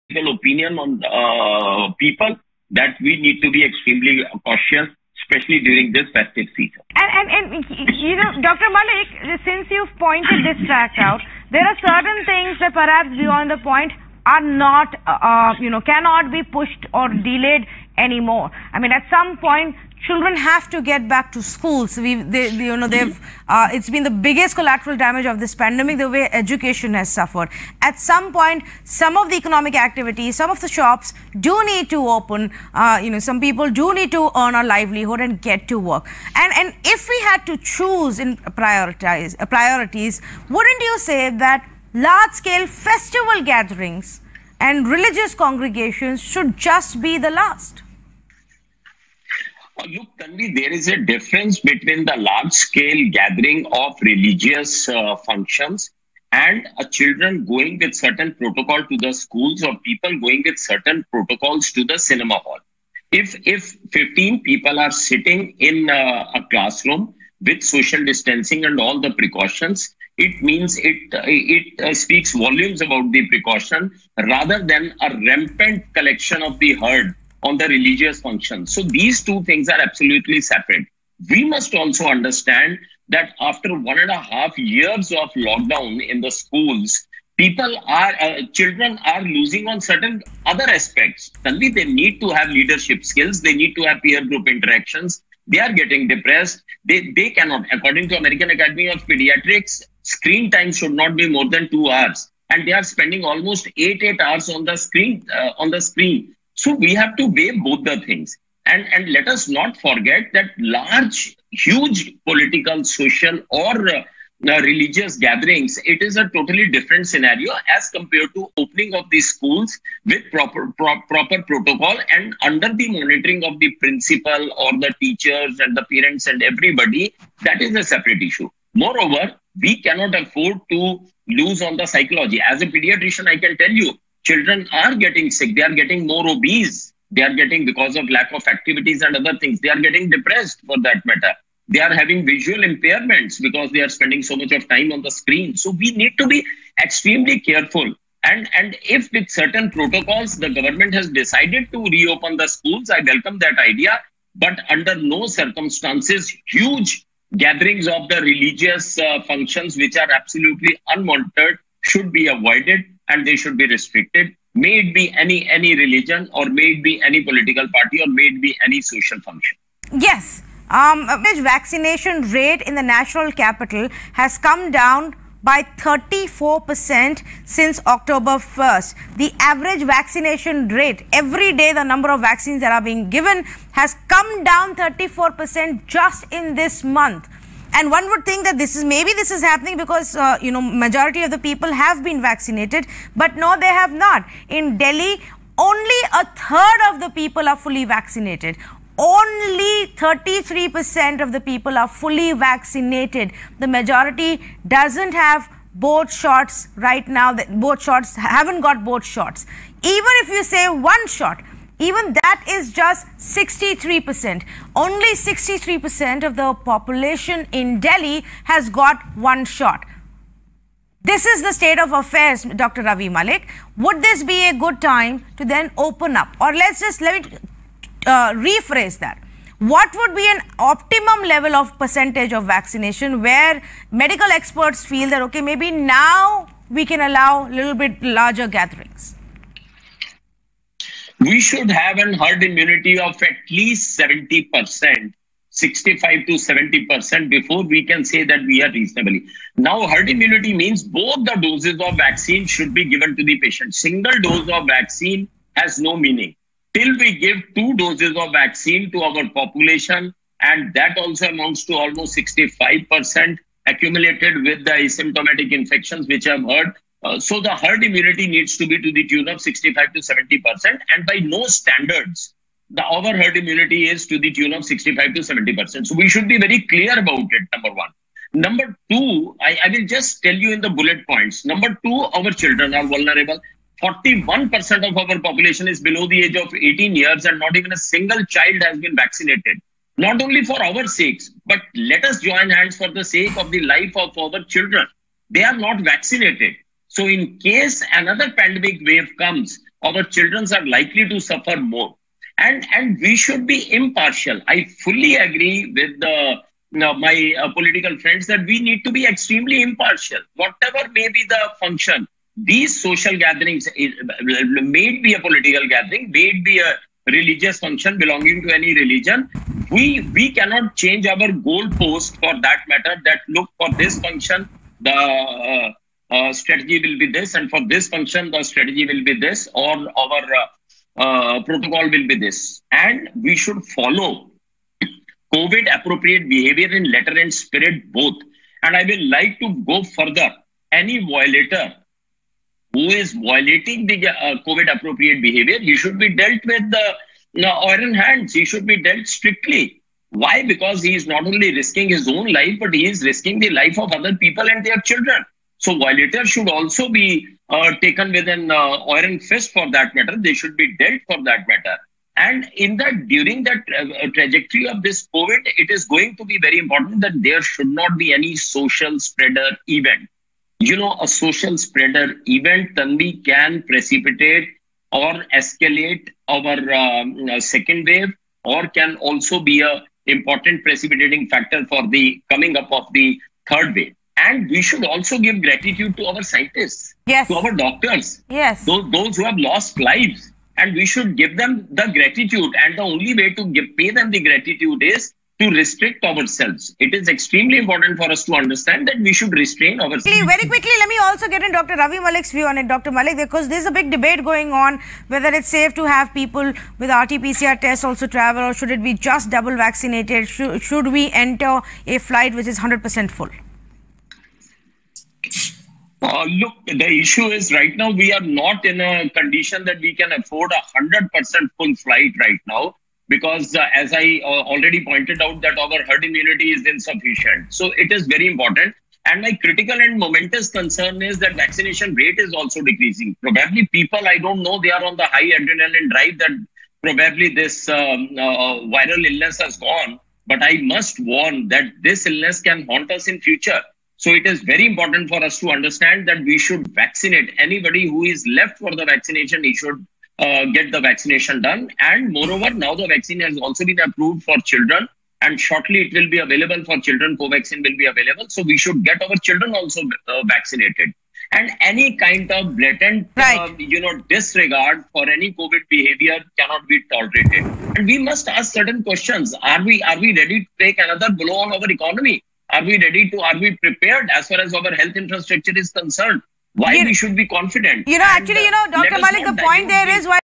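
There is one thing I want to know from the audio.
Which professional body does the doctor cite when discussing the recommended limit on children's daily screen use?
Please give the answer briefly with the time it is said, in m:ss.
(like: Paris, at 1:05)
American Academy of Pediatrics, at 1:38.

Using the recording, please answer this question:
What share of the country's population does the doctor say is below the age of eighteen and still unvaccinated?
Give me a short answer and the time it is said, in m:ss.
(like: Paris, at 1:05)
41%, at 4:43.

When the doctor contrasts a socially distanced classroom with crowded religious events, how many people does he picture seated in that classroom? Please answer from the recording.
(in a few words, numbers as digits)
15.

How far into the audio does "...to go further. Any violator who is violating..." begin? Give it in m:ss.
5:39.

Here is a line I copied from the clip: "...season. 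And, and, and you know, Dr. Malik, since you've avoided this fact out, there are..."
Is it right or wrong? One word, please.
wrong.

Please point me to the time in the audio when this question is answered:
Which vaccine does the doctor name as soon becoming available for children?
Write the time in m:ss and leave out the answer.
7:37.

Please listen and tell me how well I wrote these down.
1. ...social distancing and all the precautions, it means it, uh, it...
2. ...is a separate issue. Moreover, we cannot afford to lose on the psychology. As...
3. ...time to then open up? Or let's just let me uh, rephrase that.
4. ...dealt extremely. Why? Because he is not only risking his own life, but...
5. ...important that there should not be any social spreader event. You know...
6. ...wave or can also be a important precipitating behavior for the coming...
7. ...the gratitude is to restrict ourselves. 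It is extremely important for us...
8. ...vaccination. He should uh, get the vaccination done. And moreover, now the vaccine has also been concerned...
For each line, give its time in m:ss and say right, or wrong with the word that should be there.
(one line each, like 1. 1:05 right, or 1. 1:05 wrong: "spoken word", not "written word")
1. 1:07 right
2. 2:07 right
3. 3:44 right
4. 5:48 wrong: "strictly", not "extremely"
5. 6:06 right
6. 6:17 wrong: "factor", not "behavior"
7. 6:34 right
8. 7:28 wrong: "approved", not "concerned".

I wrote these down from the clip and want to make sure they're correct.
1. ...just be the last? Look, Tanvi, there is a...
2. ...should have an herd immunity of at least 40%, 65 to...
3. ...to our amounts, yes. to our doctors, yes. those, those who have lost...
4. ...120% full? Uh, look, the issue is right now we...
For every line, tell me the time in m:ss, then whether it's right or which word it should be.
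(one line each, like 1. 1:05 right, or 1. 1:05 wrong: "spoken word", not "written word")
1. 0:46 right
2. 4:01 wrong: "70", not "40"
3. 6:25 wrong: "scientists", not "amounts"
4. 6:52 wrong: "100", not "120".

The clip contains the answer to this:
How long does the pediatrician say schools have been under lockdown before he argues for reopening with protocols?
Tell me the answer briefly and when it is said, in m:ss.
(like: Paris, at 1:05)
One and a half years, at 1:23.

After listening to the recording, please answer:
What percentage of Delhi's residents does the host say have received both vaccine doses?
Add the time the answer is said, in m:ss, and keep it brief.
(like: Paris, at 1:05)
33%, at 3:19.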